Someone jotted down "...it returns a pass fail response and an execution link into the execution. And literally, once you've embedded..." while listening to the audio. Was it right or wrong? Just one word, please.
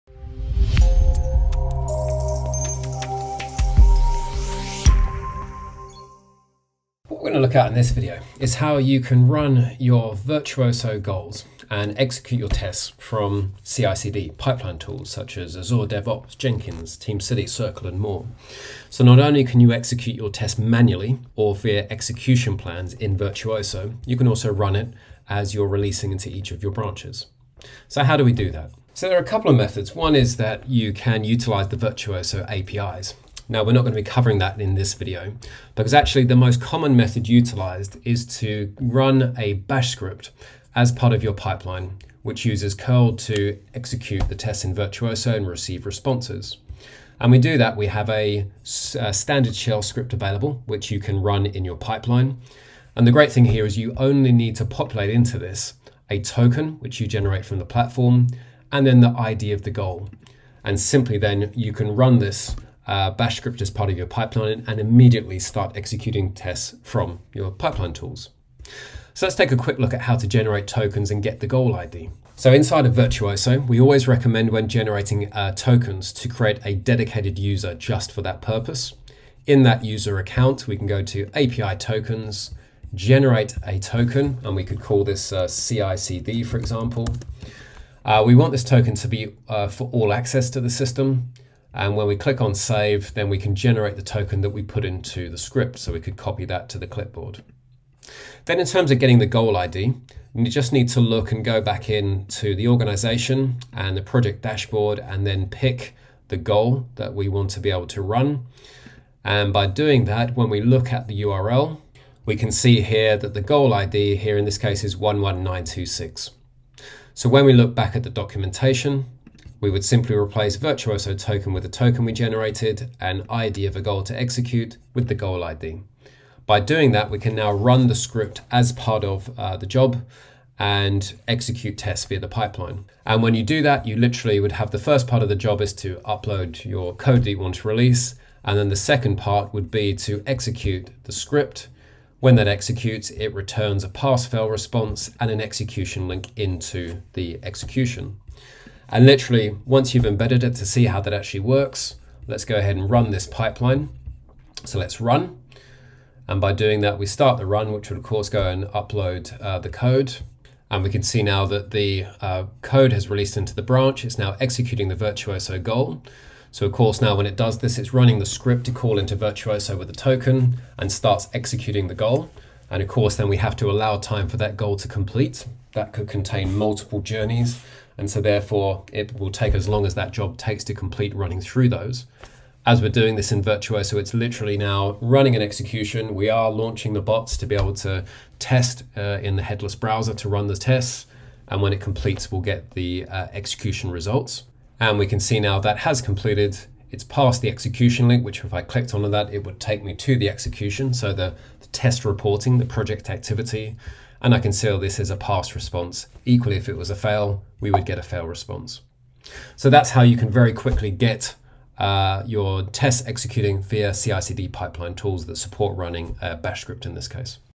right.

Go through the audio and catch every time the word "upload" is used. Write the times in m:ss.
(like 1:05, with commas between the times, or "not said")
2:15, 2:38.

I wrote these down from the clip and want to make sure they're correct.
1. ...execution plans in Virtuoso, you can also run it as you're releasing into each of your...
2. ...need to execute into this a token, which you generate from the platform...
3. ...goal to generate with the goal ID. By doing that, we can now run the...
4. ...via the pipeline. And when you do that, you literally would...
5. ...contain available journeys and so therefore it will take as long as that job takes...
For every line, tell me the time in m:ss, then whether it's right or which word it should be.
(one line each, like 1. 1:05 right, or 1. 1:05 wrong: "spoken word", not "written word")
1. 0:21 right
2. 0:54 wrong: "populate", not "execute"
3. 2:03 wrong: "execute", not "generate"
4. 2:12 right
5. 2:56 wrong: "multiple", not "available".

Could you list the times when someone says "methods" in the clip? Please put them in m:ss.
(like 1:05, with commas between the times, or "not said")
0:29, 0:36.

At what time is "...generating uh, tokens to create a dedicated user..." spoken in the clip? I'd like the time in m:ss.
1:14.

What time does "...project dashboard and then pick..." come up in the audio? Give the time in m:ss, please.
1:44.